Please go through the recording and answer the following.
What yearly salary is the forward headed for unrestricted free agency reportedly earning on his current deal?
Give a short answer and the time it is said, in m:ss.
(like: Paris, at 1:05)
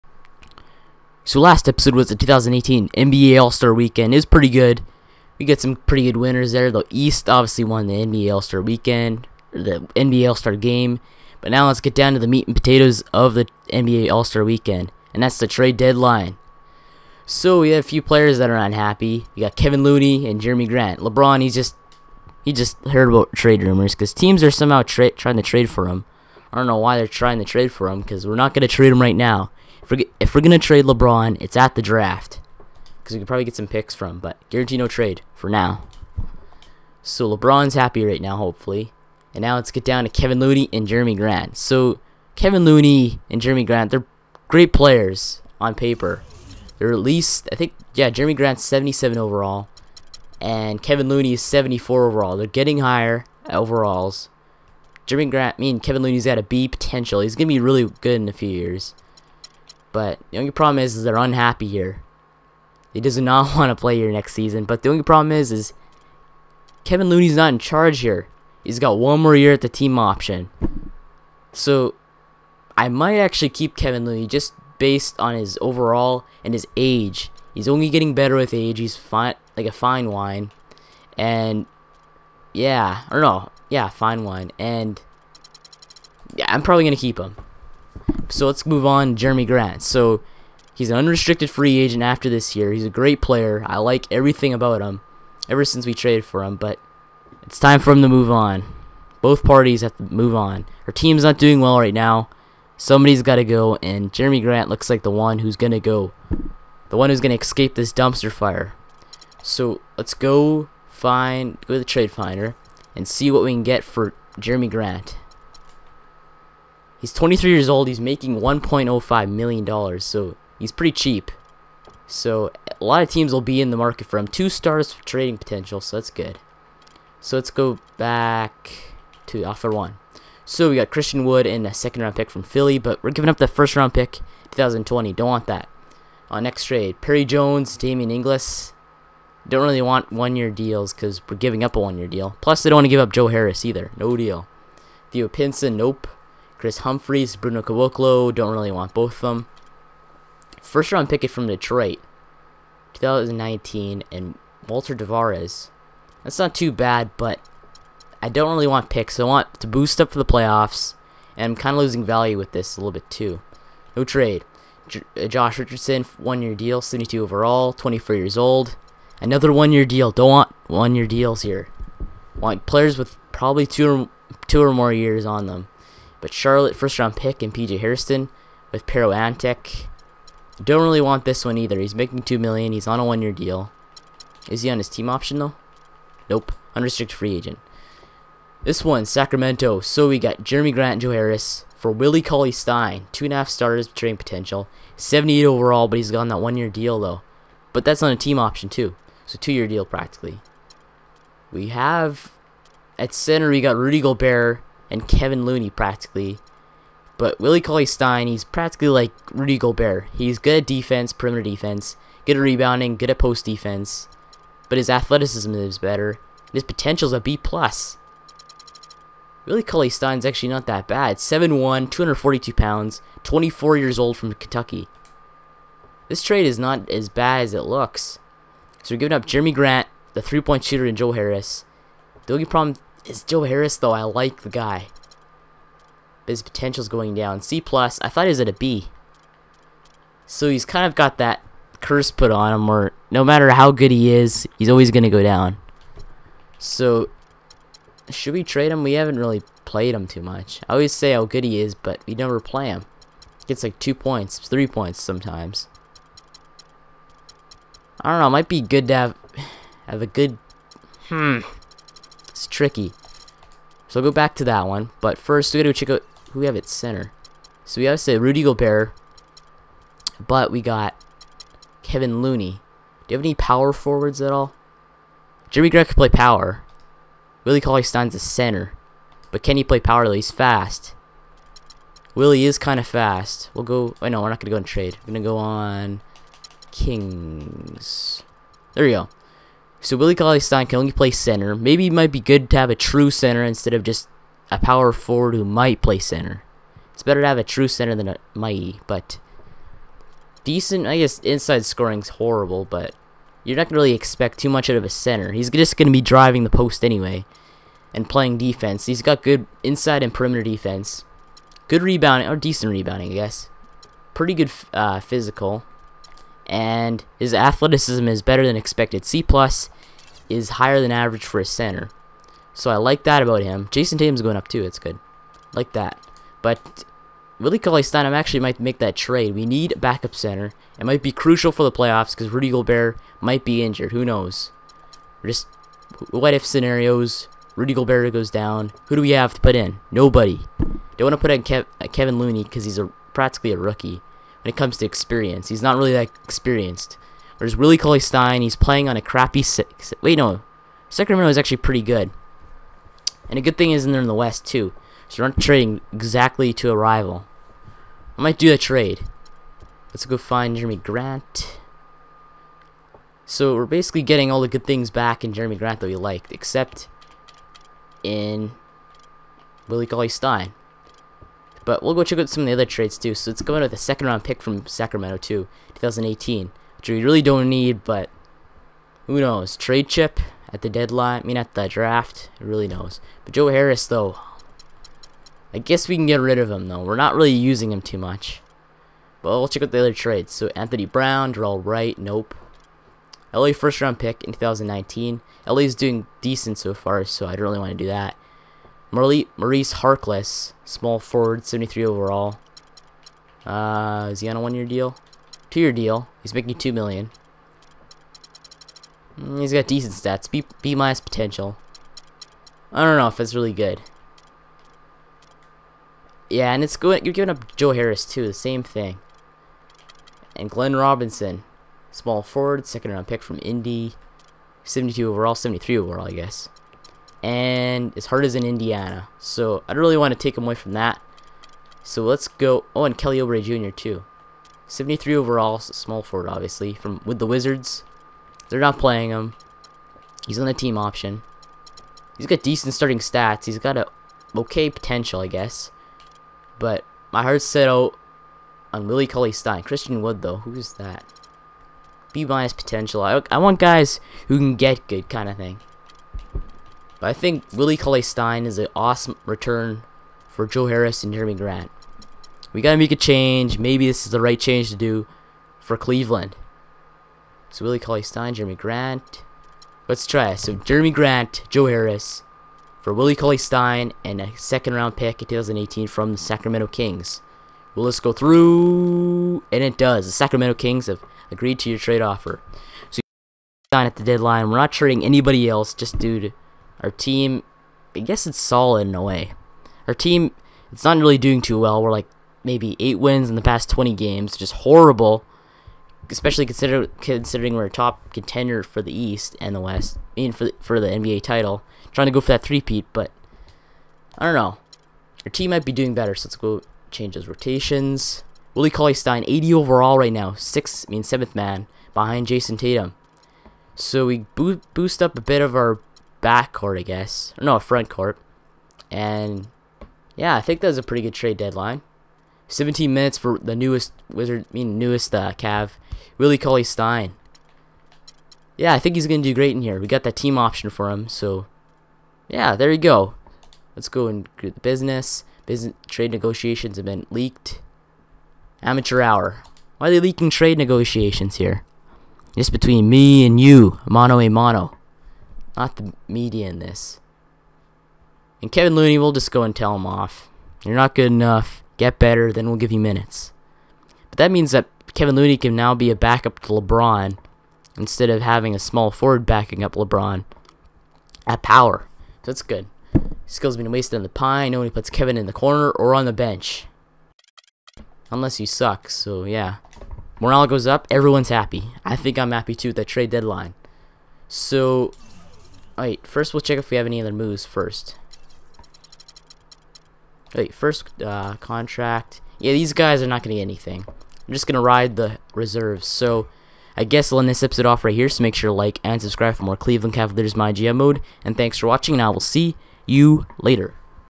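1.05 million dollars, at 1:58.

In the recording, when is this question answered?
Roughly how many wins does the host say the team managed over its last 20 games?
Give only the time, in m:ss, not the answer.
8:12.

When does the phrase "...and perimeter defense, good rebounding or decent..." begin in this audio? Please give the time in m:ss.
5:10.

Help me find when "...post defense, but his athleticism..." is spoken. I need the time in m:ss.
3:33.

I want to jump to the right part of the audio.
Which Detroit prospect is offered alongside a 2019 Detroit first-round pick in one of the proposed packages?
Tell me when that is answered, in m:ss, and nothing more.
2:34.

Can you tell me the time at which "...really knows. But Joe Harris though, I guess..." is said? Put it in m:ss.
6:22.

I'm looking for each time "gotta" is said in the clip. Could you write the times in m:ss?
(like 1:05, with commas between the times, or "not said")
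4:25, 7:42.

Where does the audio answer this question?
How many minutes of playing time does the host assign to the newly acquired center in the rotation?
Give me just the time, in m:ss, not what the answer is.
8:42.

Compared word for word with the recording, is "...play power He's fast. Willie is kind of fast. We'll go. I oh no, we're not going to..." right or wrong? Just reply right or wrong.
right.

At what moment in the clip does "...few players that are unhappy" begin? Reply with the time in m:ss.
0:17.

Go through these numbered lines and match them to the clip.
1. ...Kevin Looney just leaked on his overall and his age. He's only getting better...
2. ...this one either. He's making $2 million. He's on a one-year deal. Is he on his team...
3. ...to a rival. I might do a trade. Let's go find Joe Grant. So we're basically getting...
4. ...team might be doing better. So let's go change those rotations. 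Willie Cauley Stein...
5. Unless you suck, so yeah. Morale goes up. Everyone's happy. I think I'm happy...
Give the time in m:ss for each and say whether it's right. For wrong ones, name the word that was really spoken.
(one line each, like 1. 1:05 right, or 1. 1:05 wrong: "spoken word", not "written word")
1. 1:13 wrong: "based", not "leaked"
2. 3:01 right
3. 5:56 wrong: "Jerami", not "Joe"
4. 8:25 right
5. 9:28 right.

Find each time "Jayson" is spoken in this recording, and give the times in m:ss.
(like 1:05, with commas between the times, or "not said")
5:23, 8:32.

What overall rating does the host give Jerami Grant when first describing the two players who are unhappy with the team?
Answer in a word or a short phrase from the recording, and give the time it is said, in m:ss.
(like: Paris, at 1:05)
77, at 0:48.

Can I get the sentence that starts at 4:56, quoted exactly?
It's better to have a true center than a mighty, but decent.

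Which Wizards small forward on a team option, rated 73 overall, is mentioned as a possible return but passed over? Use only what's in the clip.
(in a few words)
Kelly Oubre Jr.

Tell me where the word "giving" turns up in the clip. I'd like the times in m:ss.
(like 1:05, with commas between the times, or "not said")
2:13, 2:21, 3:48, 6:57.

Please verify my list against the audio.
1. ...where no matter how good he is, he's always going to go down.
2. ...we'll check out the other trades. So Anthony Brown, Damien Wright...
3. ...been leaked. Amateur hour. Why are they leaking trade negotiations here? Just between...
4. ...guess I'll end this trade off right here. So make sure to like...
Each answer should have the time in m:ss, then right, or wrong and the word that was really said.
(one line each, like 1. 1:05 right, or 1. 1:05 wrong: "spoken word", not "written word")
1. 4:02 right
2. 6:29 wrong: "Darrell", not "Damien"
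3. 8:56 right
4. 9:46 wrong: "episode", not "trade".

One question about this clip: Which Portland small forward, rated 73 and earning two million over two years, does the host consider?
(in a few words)
Maurice Harkless.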